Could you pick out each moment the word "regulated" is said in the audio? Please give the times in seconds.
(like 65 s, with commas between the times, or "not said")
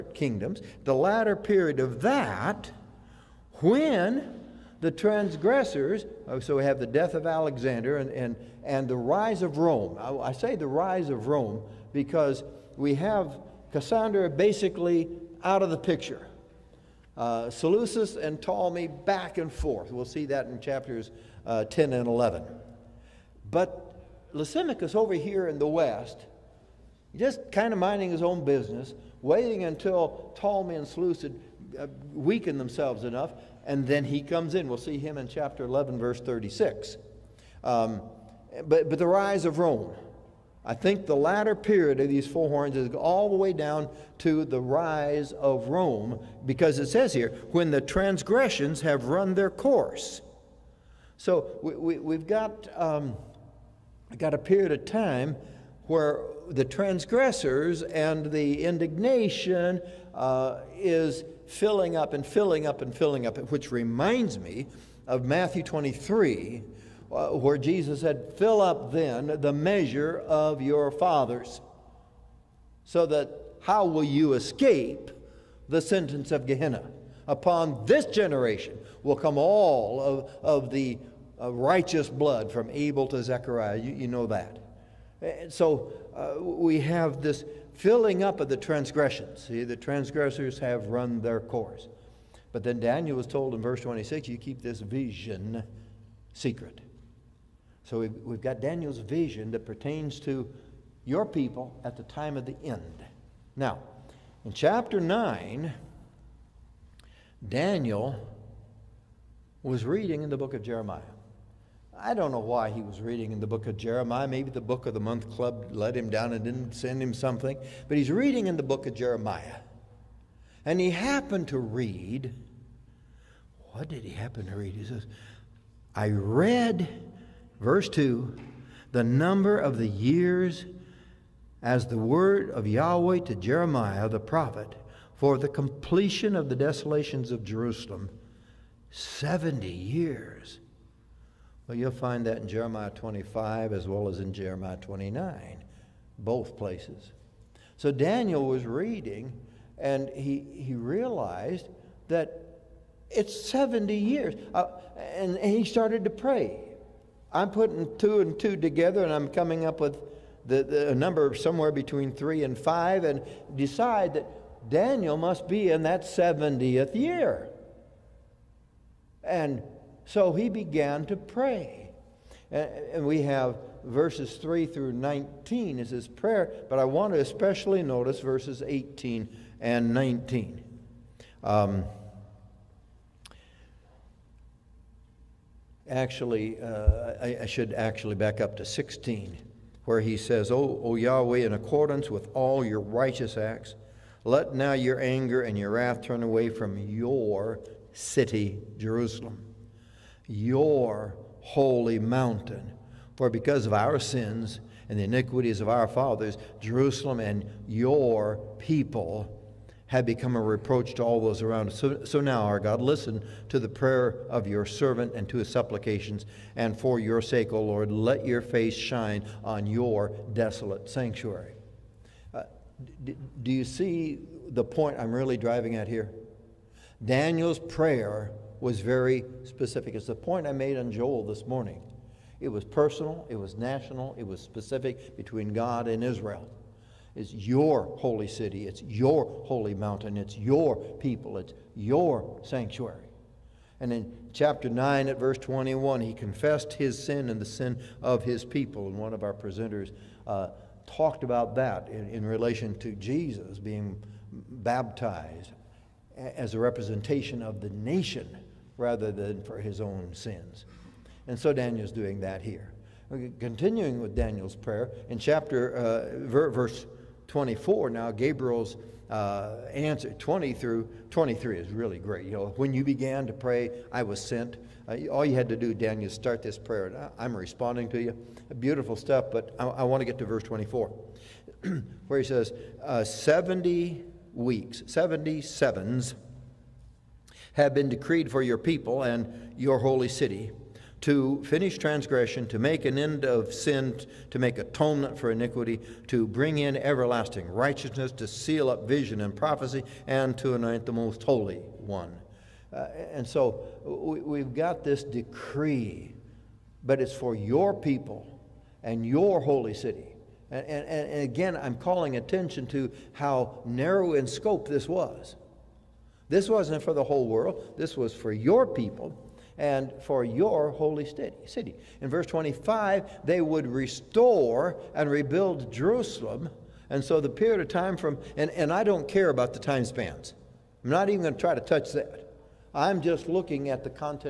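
not said.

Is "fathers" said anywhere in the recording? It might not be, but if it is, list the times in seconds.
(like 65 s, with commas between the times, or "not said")
70 s, 205 s.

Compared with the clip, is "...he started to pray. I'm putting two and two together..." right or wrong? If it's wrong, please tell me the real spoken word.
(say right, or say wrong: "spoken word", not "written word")
right.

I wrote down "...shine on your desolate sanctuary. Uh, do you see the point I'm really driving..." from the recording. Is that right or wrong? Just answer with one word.
right.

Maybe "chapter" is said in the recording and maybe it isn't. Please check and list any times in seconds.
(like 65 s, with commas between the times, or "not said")
20 s, 35 s, 104 s, 244 s, 265 s.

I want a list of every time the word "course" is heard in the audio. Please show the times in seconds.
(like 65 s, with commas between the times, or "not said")
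49 s, 91 s.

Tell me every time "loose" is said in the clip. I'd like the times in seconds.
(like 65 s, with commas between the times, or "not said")
not said.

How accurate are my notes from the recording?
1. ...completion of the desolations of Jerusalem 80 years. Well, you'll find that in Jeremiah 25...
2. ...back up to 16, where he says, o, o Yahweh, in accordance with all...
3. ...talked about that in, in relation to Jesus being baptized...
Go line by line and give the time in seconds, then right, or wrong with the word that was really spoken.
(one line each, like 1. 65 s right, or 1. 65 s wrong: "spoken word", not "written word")
1. 135 s wrong: "70", not "80"
2. 188 s right
3. 250 s right.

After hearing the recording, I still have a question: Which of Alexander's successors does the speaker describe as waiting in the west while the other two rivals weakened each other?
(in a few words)
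Lysimachus.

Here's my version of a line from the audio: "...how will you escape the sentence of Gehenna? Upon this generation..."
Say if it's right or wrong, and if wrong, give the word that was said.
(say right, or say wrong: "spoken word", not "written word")
right.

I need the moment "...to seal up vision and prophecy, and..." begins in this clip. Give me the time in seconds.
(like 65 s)
298 s.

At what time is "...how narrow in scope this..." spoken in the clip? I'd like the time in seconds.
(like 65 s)
313 s.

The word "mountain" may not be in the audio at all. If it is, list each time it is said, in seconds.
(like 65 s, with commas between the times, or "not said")
201 s, 239 s.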